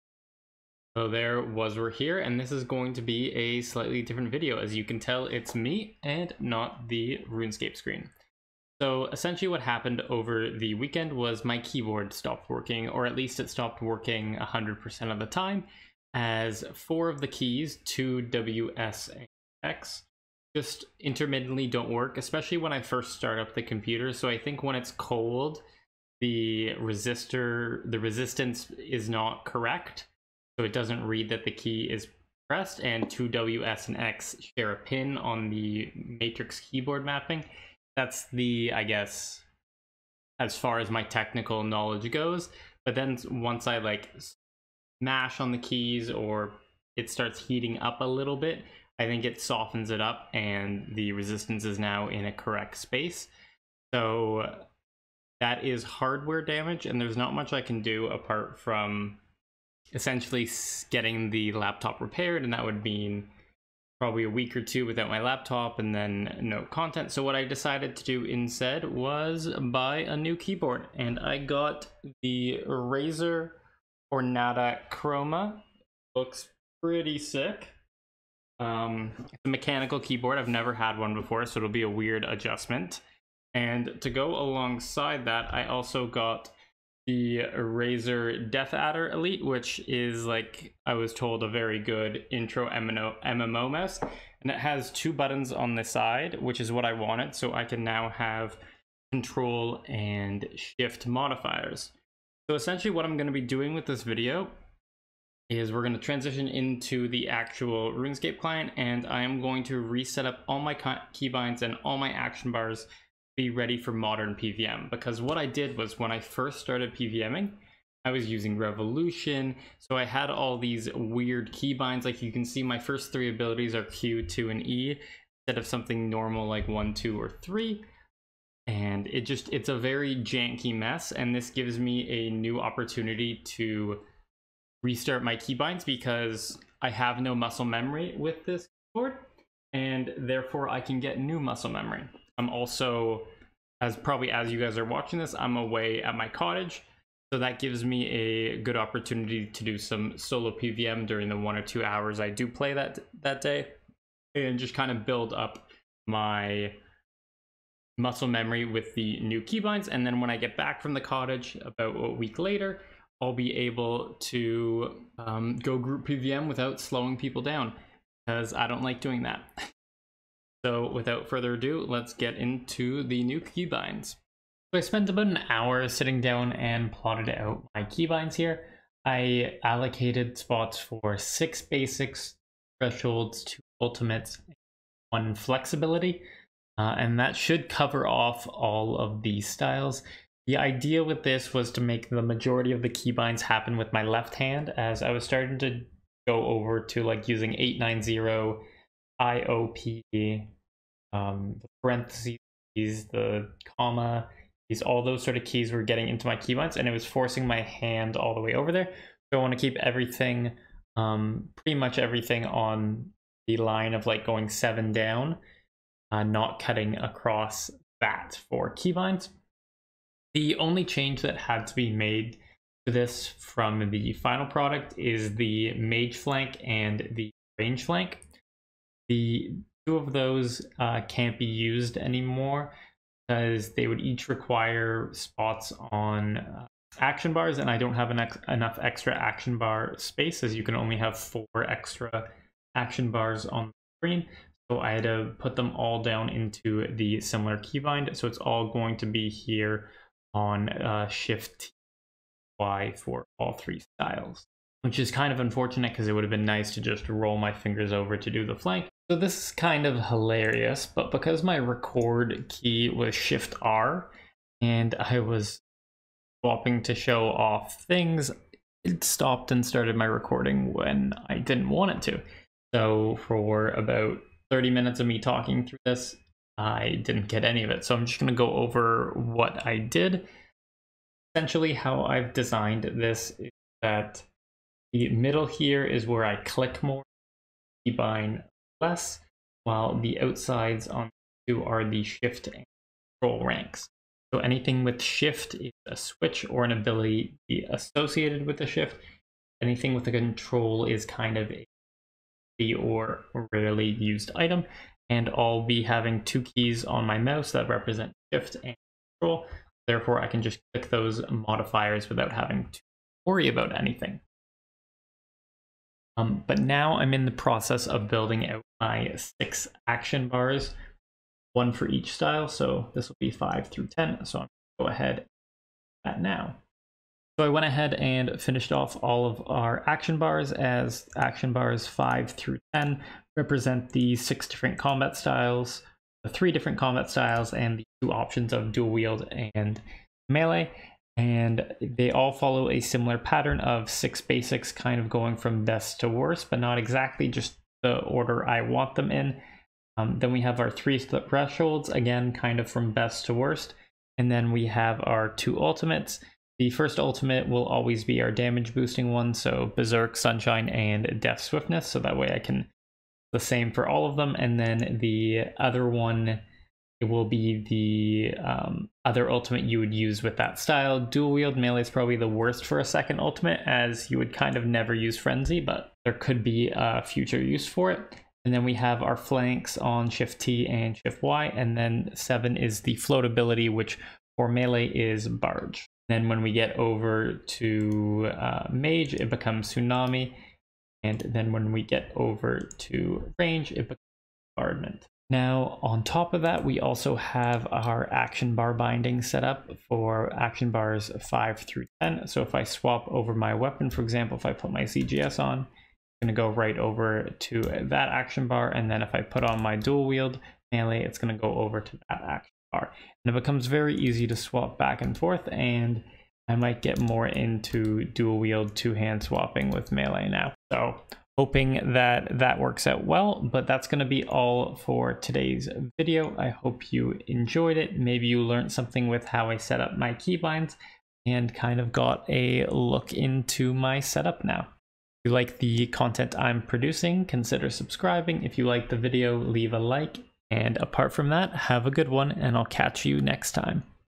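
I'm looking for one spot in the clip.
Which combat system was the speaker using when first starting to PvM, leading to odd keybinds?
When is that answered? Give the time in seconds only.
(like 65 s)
118 s.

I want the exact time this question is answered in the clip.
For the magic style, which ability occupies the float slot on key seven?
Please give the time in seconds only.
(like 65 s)
389 s.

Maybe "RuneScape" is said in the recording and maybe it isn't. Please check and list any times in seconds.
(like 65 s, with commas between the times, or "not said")
7 s, 107 s.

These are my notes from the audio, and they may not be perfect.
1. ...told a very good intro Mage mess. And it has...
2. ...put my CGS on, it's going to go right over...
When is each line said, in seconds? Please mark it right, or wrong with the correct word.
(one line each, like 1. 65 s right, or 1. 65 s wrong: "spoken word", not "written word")
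1. 91 s wrong: "MMO", not "Mage"
2. 404 s right.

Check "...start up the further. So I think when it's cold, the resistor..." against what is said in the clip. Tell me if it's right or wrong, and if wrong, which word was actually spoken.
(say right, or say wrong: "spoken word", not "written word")
wrong: "computer", not "further".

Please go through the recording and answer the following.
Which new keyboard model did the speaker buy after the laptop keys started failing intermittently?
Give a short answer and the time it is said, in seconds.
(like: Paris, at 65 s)
Razer Ornata Chroma, at 72 s.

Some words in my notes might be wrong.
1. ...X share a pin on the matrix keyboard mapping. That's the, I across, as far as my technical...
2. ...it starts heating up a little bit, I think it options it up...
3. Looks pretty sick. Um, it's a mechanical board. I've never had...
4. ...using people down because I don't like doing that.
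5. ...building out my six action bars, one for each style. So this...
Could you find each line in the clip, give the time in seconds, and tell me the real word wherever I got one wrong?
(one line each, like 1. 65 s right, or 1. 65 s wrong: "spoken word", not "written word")
1. 33 s wrong: "guess", not "across"
2. 46 s wrong: "softens", not "options"
3. 76 s wrong: "keyboard", not "board"
4. 166 s wrong: "slowing", not "using"
5. 318 s right.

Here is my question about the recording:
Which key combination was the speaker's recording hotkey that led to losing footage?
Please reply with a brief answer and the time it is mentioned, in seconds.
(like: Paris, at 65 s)
Shift R, at 263 s.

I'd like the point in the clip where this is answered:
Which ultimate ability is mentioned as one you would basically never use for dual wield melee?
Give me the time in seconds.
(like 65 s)
375 s.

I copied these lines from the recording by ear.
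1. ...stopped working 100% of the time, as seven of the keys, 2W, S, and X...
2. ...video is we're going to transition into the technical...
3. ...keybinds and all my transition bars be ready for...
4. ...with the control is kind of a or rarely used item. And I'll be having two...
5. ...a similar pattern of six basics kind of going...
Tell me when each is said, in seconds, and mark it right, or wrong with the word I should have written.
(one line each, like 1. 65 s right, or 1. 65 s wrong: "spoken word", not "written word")
1. 13 s wrong: "four", not "seven"
2. 104 s wrong: "actual", not "technical"
3. 110 s wrong: "action", not "transition"
4. 299 s right
5. 342 s right.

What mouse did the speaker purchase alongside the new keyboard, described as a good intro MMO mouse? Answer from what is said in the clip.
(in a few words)
Razer DeathAdder Elite.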